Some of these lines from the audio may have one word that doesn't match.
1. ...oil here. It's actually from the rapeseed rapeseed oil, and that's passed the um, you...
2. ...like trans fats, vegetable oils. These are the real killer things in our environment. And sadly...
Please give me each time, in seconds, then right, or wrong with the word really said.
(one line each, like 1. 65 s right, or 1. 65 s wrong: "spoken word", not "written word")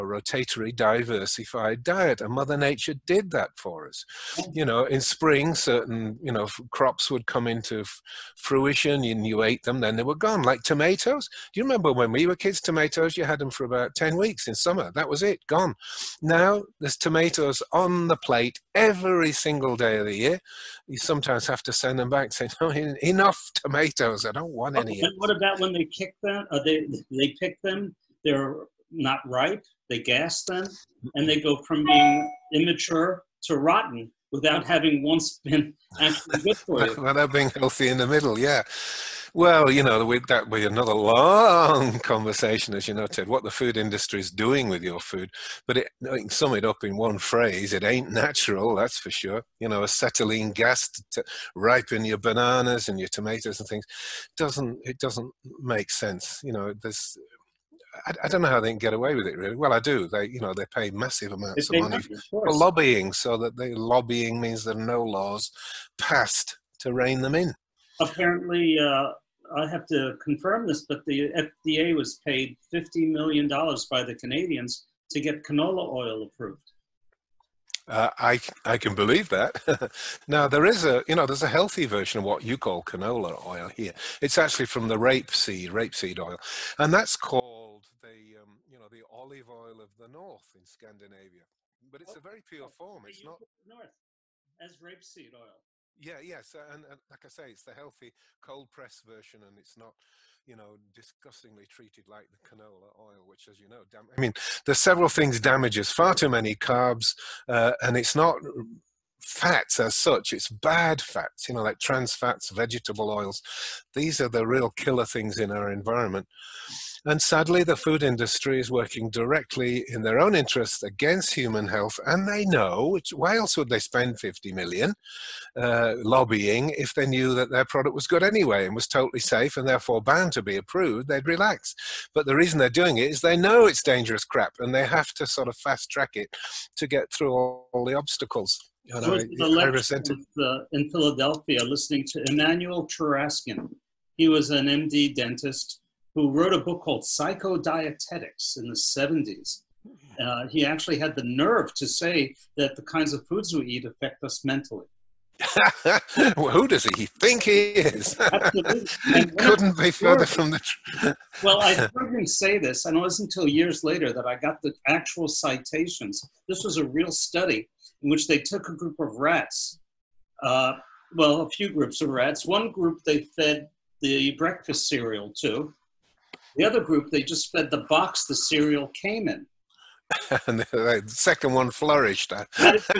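1. 83 s wrong: "called", not "passed"
2. 111 s right.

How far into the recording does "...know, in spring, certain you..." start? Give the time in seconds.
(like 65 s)
4 s.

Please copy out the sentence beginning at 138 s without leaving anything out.
You know, I, I With, uh, in Philadelphia listening to Emmanuel Cheraskin.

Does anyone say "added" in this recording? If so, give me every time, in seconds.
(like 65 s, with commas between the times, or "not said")
not said.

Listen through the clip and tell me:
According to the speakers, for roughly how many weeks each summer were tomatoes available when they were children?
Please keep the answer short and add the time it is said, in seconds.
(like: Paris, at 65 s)
10 weeks, at 13 s.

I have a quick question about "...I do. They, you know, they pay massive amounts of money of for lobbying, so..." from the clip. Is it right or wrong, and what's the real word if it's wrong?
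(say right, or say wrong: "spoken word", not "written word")
right.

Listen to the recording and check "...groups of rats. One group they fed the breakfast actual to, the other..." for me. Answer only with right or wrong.
wrong.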